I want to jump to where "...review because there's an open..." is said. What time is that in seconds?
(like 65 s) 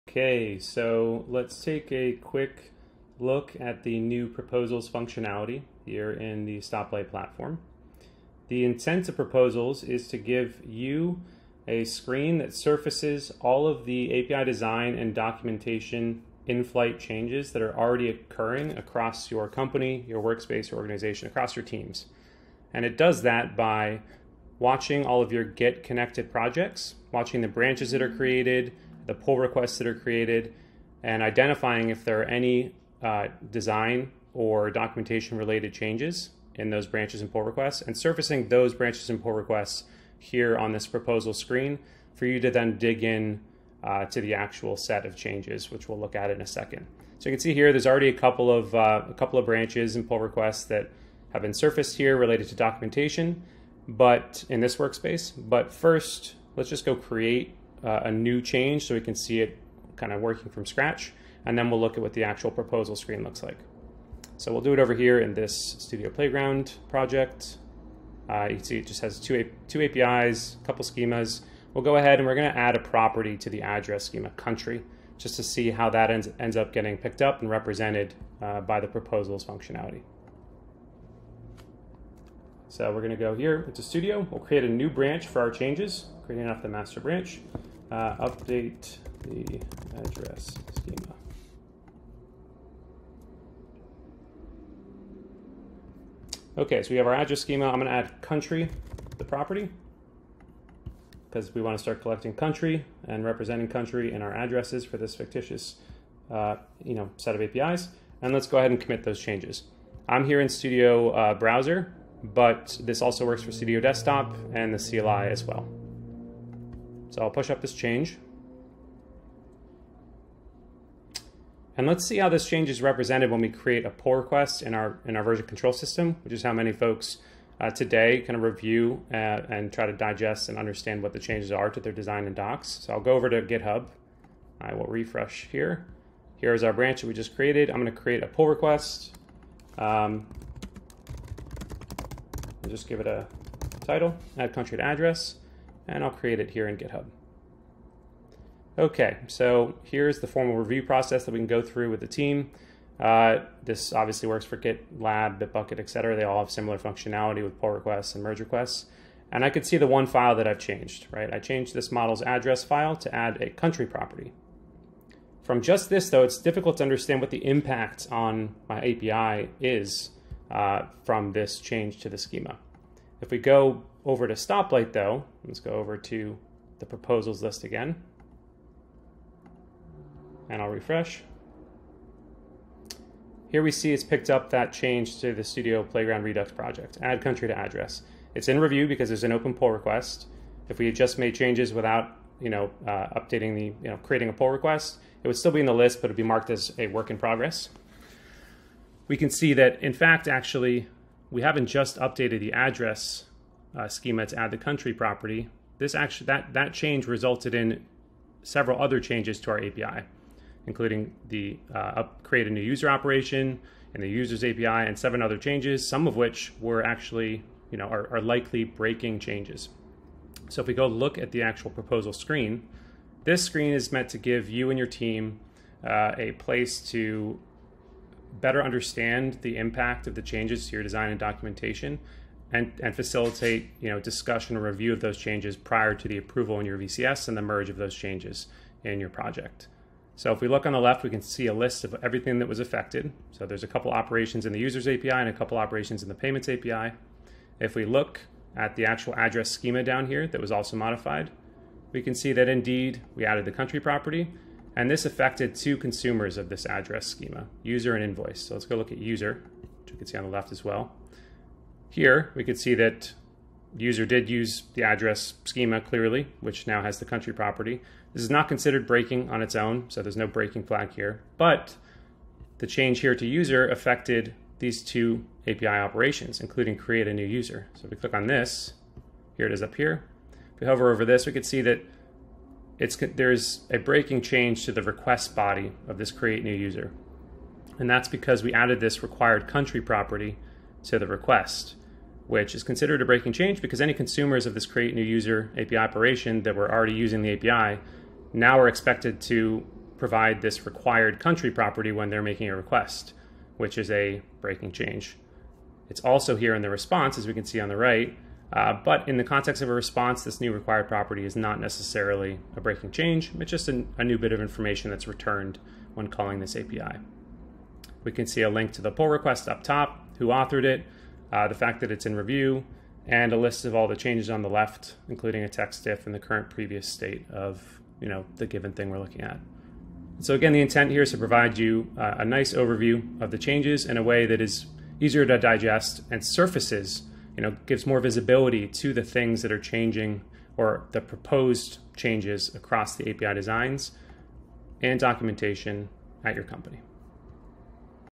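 188 s.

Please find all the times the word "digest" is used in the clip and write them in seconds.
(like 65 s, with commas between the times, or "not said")
129 s, 335 s.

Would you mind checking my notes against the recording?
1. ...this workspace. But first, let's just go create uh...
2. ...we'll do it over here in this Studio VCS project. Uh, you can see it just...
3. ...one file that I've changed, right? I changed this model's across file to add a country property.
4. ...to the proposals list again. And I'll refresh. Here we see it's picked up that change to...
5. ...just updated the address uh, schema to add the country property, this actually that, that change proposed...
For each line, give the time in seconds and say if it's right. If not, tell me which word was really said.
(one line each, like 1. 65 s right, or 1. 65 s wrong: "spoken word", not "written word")
1. 54 s right
2. 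64 s wrong: "Playground", not "VCS"
3. 159 s wrong: "address", not "across"
4. 175 s right
5. 201 s wrong: "resulted", not "proposed".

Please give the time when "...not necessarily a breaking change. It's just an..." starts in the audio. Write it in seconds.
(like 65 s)
311 s.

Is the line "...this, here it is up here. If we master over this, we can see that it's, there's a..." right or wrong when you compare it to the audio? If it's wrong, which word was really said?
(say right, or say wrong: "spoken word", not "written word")
wrong: "hover", not "master".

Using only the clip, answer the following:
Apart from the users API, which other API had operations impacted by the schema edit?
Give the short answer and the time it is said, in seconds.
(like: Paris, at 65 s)
payments API, at 246 s.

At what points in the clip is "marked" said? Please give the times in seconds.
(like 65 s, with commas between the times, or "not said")
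196 s.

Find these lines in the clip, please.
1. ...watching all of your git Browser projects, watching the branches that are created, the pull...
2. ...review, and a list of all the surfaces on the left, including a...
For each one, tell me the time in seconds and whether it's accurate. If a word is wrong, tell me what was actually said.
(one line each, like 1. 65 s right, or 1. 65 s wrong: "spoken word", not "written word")
1. 24 s wrong: "Connected", not "Browser"
2. 322 s wrong: "changes", not "surfaces".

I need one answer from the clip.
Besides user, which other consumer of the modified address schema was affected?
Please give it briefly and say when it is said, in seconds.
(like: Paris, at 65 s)
invoice, at 258 s.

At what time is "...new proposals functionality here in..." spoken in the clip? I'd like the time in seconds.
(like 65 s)
3 s.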